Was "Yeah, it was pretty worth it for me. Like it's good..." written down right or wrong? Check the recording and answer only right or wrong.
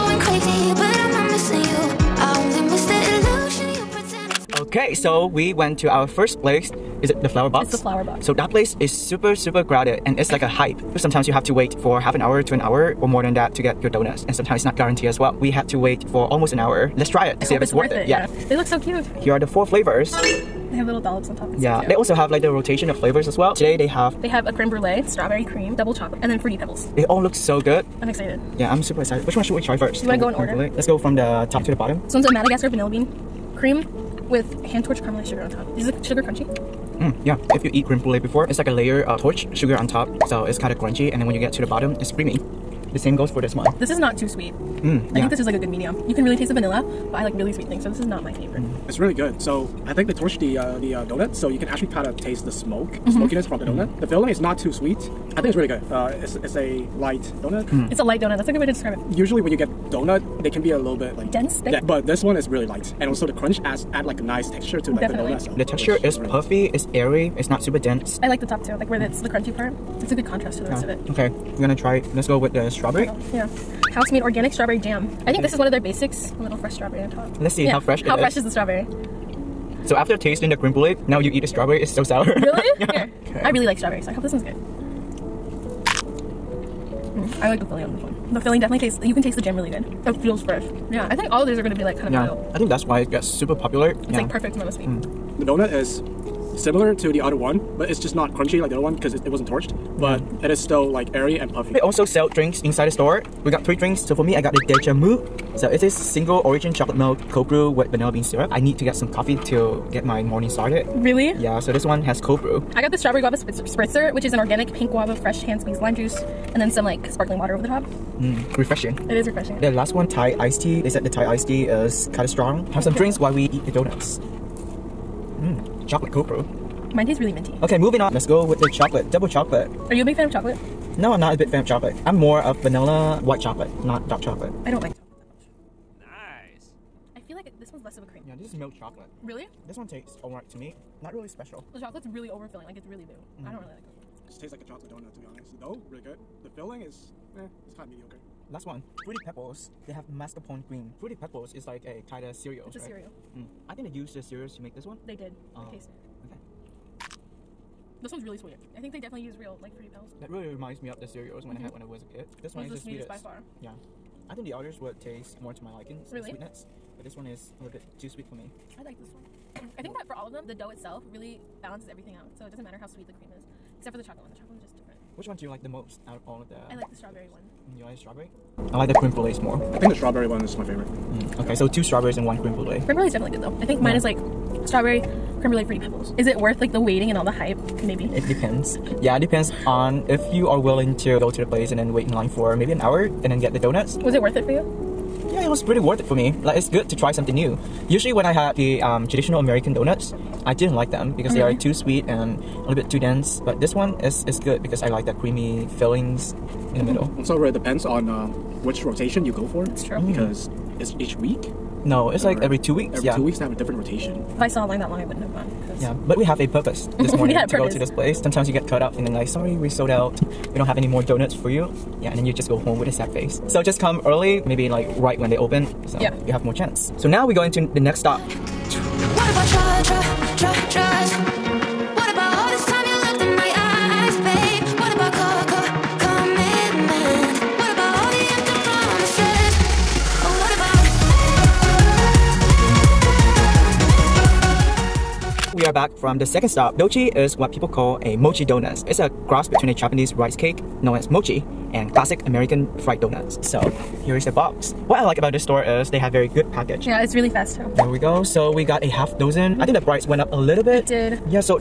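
right.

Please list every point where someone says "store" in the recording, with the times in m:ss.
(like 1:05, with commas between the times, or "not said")
1:42, 4:15.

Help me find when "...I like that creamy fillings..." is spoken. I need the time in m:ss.
3:24.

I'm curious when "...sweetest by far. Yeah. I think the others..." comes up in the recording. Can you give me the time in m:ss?
2:43.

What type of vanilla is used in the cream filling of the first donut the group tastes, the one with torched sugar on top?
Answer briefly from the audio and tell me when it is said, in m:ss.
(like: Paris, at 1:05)
Madagascar vanilla bean, at 0:32.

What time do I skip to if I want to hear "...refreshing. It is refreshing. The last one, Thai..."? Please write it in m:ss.
1:58.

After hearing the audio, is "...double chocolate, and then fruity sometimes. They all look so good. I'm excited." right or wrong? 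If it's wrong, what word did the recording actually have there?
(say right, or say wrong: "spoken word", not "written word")
wrong: "pebbles", not "sometimes".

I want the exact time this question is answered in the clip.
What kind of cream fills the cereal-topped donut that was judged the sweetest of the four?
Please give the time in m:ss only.
2:30.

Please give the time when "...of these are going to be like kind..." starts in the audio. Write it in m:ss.
1:31.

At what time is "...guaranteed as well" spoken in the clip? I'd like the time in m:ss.
0:14.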